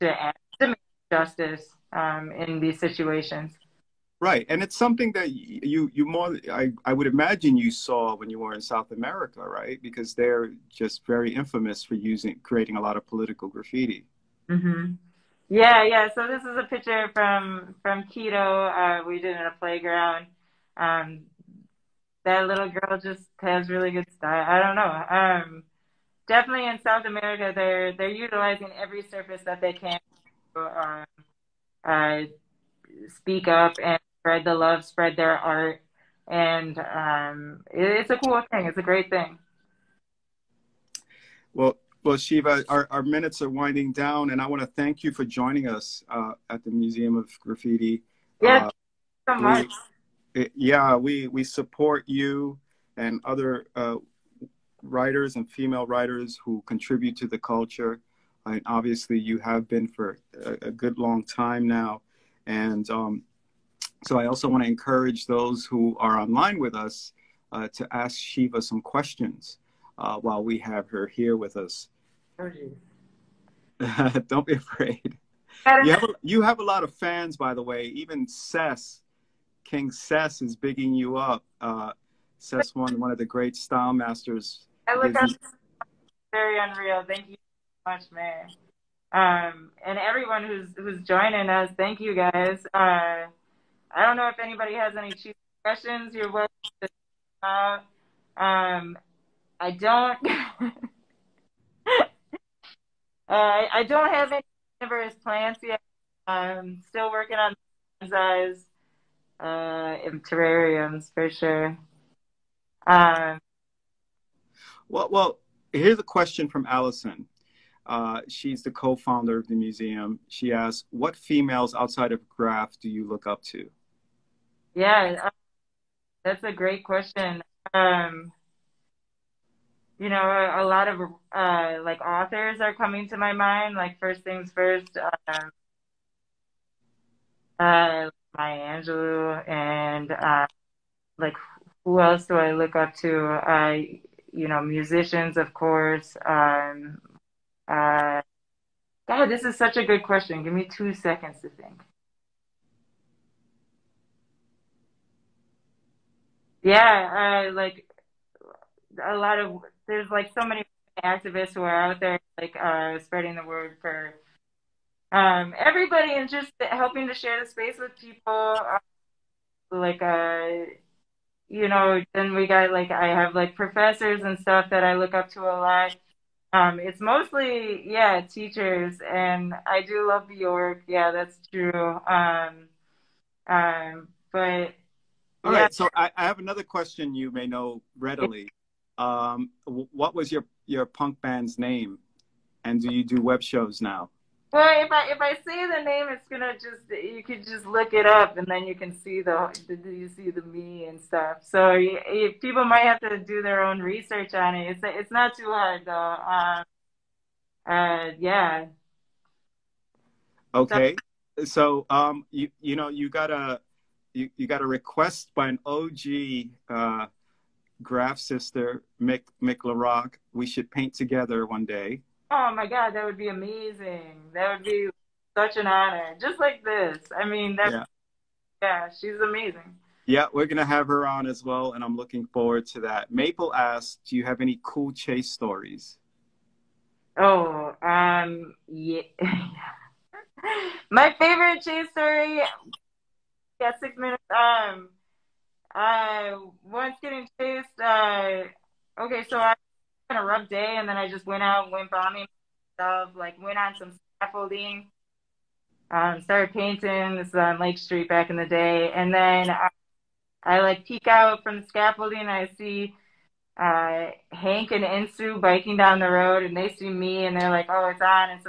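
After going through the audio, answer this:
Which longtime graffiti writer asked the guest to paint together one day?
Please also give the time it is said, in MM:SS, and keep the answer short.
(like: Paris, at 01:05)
Mick LaRock, at 03:39.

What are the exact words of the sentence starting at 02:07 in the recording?
Um, you know, a, a lot of uh, like authors are coming to my mind.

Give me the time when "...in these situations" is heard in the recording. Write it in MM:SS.
00:02.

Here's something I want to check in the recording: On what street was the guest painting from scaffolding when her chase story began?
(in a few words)
Lake Street.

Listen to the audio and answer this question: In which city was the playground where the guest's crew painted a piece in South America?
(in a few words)
Quito.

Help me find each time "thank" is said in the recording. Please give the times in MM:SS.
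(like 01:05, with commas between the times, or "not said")
00:44, 01:27, 01:31.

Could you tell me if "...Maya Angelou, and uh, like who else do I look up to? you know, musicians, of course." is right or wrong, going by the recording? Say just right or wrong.
right.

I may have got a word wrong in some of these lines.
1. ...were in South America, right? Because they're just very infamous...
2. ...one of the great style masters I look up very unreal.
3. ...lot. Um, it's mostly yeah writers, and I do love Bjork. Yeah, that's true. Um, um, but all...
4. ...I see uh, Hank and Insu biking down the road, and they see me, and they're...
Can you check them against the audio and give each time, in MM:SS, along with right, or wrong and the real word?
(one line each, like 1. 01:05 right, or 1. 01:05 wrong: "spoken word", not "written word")
1. 00:08 right
2. 01:22 right
3. 02:55 wrong: "teachers", not "writers"
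4. 04:22 right.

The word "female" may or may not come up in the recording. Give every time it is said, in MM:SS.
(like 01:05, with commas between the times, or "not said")
00:55, 02:01.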